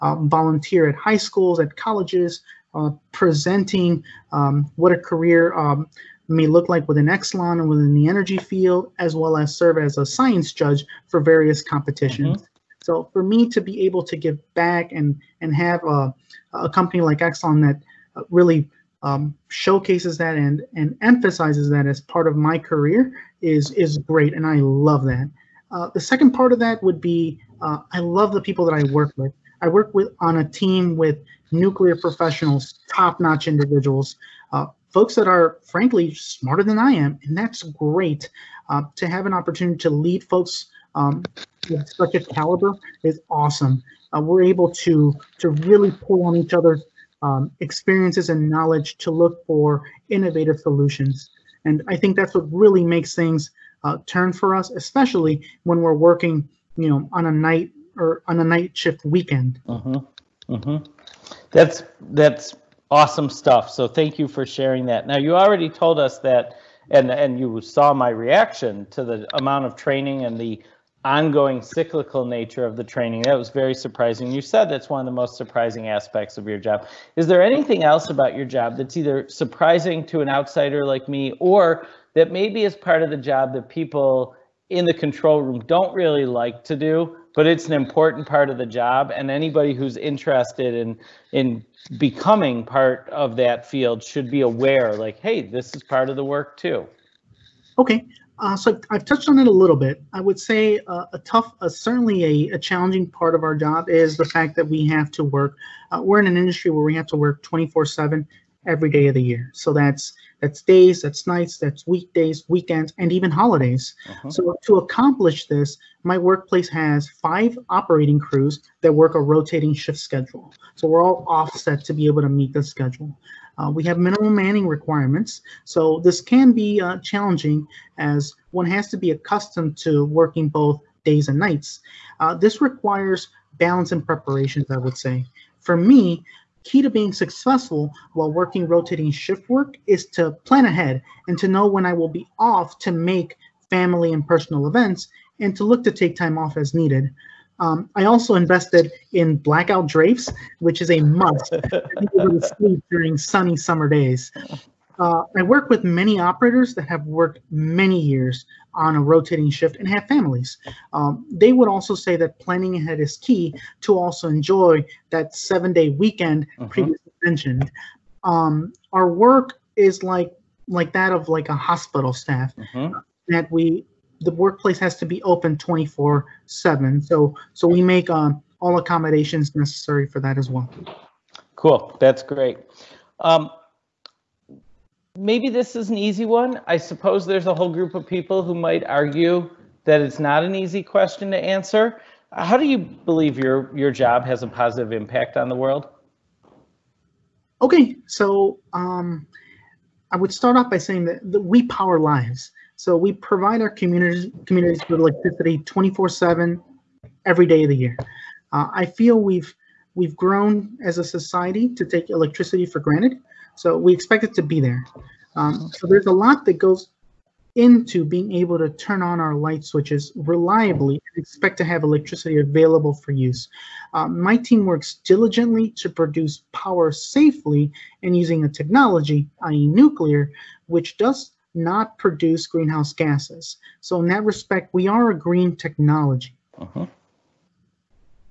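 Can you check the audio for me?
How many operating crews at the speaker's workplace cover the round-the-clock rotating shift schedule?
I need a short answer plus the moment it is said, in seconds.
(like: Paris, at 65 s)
5, at 117 s.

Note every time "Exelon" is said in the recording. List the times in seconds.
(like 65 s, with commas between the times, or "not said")
7 s, 17 s.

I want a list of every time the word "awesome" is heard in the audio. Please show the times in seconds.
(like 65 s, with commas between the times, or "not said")
43 s, 62 s.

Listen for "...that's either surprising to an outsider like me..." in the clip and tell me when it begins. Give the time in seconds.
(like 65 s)
78 s.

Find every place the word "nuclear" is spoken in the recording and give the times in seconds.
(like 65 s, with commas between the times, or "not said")
31 s, 229 s.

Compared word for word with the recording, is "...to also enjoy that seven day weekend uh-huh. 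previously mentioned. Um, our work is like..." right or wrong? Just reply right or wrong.
right.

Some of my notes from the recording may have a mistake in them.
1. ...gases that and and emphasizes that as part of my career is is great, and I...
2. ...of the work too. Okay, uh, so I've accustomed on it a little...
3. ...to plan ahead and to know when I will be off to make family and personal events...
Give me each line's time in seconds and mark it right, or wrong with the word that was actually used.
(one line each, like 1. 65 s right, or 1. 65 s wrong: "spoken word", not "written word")
1. 19 s wrong: "showcases", not "gases"
2. 96 s wrong: "touched", not "accustomed"
3. 140 s right.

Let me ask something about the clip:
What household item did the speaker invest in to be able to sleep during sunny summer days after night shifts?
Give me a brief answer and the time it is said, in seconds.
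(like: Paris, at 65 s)
Blackout drapes, at 149 s.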